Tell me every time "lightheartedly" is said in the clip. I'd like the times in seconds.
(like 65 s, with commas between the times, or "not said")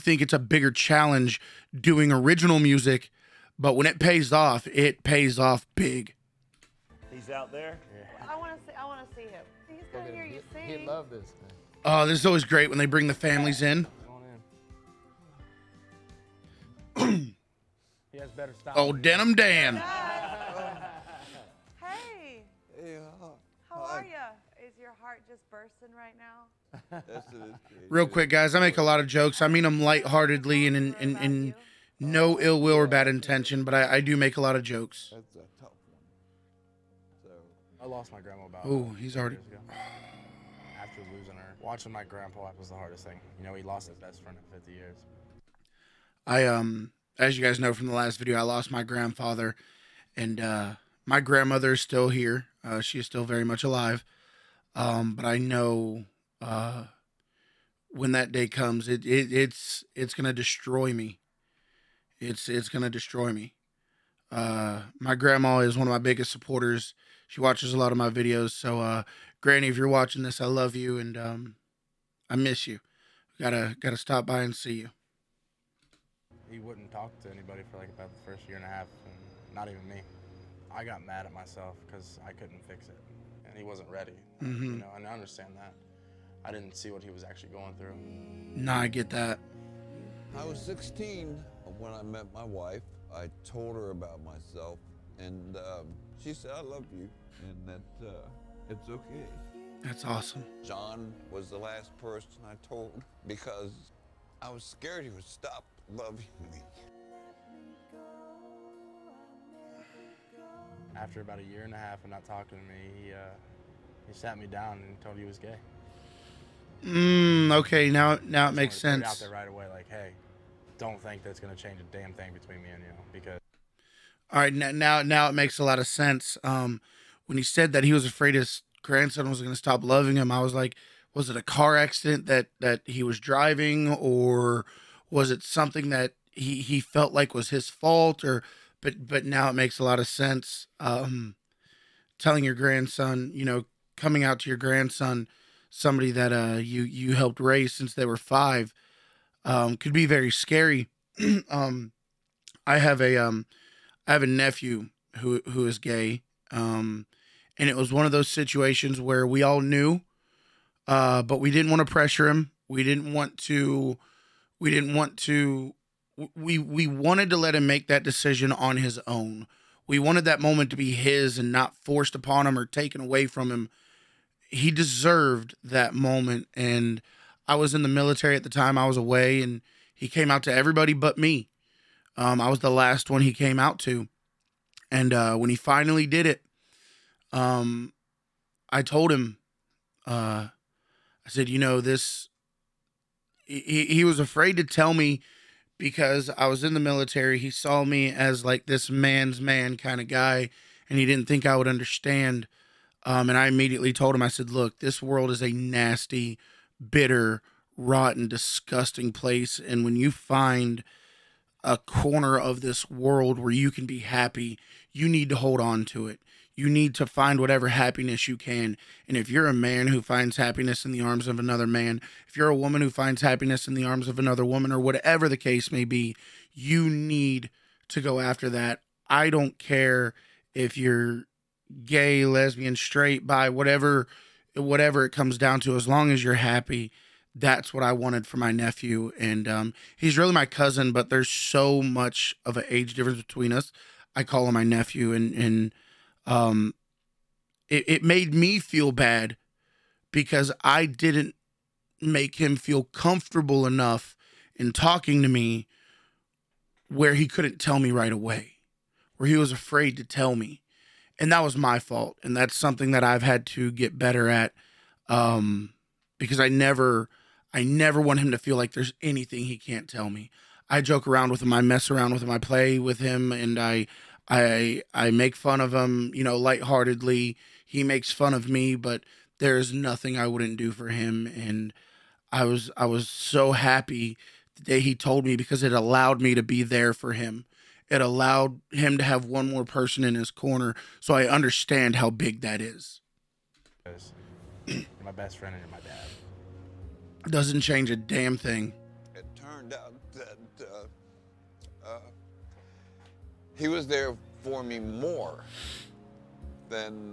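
29 s, 276 s.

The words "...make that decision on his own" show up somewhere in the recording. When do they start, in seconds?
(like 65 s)
167 s.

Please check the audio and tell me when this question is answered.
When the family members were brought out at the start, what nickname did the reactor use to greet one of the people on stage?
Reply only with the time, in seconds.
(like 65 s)
18 s.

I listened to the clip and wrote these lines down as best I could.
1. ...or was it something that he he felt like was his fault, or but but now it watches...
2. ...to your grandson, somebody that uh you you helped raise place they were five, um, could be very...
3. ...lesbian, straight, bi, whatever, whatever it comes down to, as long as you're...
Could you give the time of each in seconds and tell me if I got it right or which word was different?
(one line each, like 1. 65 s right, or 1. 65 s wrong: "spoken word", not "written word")
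1. 133 s wrong: "makes", not "watches"
2. 144 s wrong: "since", not "place"
3. 232 s right.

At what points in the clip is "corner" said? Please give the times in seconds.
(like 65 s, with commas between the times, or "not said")
211 s, 290 s.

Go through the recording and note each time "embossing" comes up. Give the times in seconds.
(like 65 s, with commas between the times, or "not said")
not said.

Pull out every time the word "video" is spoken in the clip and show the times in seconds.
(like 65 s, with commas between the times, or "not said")
48 s, 68 s.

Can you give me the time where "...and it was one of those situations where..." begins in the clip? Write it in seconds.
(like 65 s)
157 s.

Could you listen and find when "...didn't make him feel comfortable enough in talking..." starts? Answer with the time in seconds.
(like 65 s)
250 s.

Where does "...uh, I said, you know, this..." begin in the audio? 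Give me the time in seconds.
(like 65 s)
190 s.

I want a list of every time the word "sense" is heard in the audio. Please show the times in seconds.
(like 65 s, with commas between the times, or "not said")
118 s, 125 s, 140 s.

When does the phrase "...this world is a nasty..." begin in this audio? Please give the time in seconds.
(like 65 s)
204 s.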